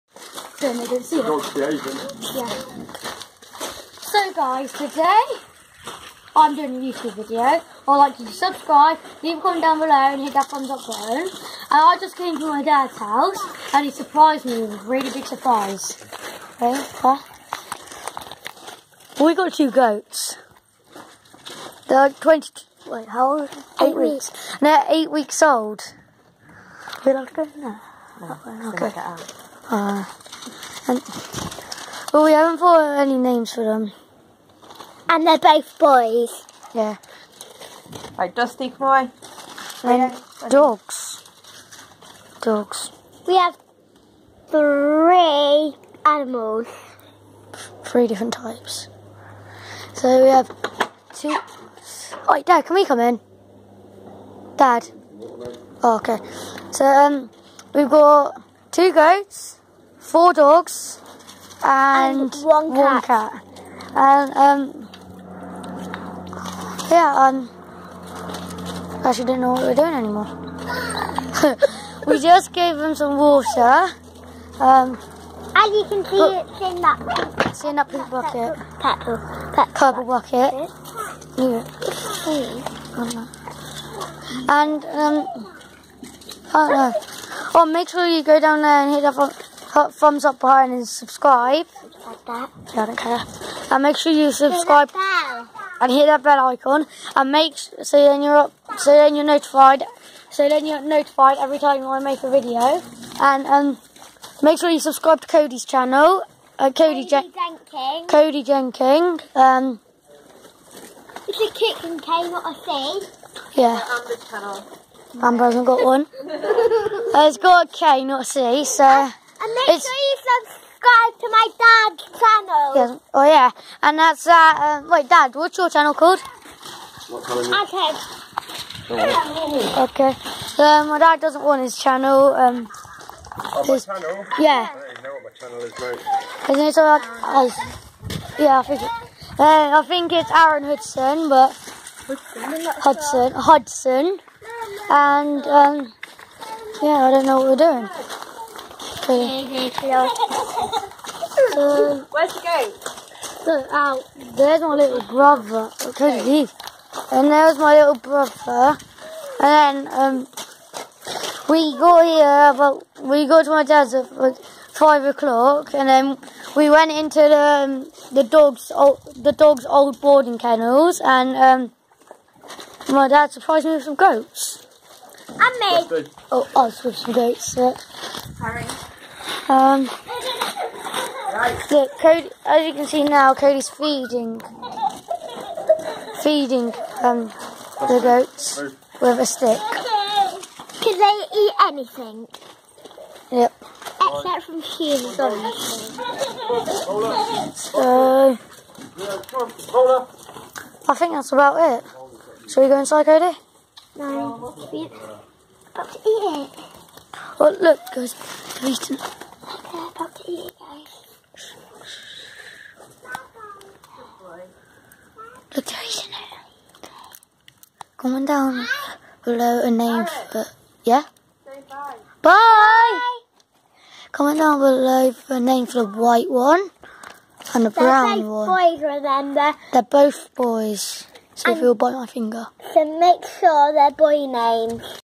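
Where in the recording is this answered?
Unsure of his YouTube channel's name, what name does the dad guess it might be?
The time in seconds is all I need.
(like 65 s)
140 s.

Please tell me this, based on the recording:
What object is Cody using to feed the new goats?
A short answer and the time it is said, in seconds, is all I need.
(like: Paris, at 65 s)
a stick, at 189 s.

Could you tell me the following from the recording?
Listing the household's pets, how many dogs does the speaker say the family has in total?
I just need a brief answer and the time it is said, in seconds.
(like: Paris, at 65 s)
4, at 60 s.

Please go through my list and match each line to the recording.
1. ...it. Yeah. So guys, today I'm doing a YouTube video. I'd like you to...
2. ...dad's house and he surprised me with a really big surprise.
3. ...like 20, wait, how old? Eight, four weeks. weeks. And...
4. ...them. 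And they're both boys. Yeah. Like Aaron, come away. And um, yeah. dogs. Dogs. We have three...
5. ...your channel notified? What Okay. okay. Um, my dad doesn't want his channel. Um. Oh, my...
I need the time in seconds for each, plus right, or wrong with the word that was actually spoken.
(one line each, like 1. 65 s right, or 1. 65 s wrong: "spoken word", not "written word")
1. 1 s right
2. 12 s right
3. 22 s wrong: "eight", not "four"
4. 33 s wrong: "Dusty", not "Aaron"
5. 125 s wrong: "called", not "notified".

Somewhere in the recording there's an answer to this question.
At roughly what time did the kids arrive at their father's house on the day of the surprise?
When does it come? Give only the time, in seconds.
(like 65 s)
164 s.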